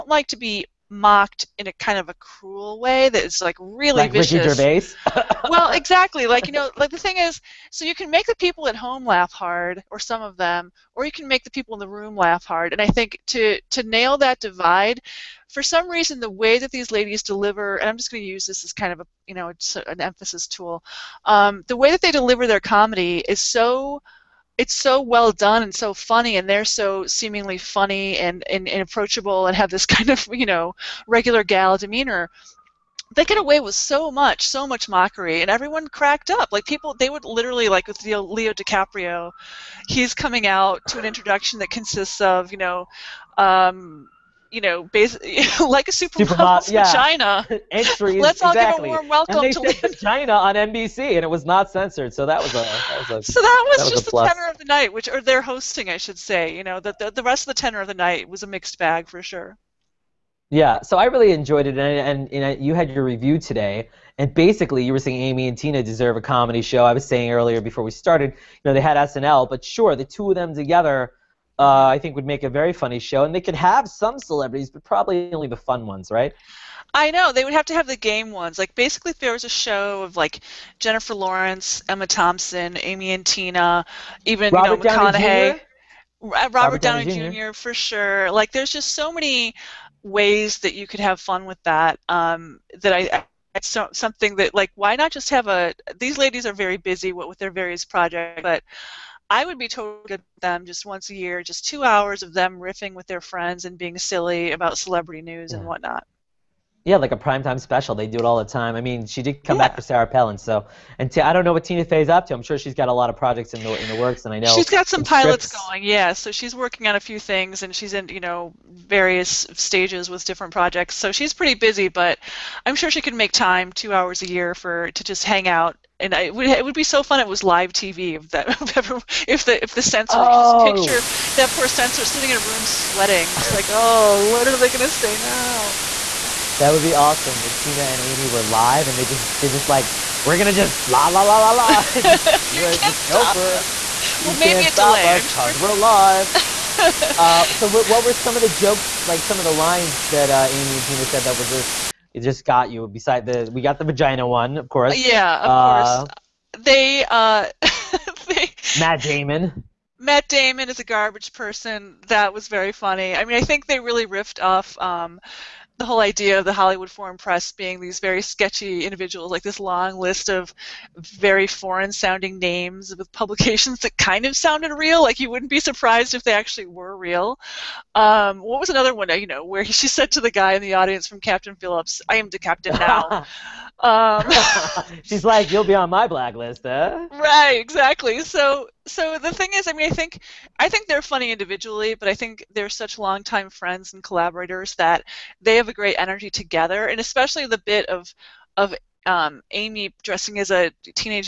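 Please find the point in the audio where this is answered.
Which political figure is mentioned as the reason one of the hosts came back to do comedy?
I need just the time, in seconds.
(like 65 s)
109 s.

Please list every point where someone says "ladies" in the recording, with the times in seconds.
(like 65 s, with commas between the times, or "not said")
16 s, 96 s.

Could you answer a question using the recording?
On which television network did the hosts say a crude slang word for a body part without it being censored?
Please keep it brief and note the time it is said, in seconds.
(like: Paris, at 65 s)
NBC, at 50 s.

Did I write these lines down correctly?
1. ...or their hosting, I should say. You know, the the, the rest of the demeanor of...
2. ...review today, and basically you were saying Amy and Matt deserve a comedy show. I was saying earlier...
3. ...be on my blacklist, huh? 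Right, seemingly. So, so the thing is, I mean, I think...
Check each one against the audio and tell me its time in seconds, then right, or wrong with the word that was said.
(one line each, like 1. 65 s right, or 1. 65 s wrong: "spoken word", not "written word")
1. 55 s wrong: "tenor", not "demeanor"
2. 63 s wrong: "Tina", not "Matt"
3. 185 s wrong: "exactly", not "seemingly".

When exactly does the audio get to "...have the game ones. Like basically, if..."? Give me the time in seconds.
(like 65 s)
77 s.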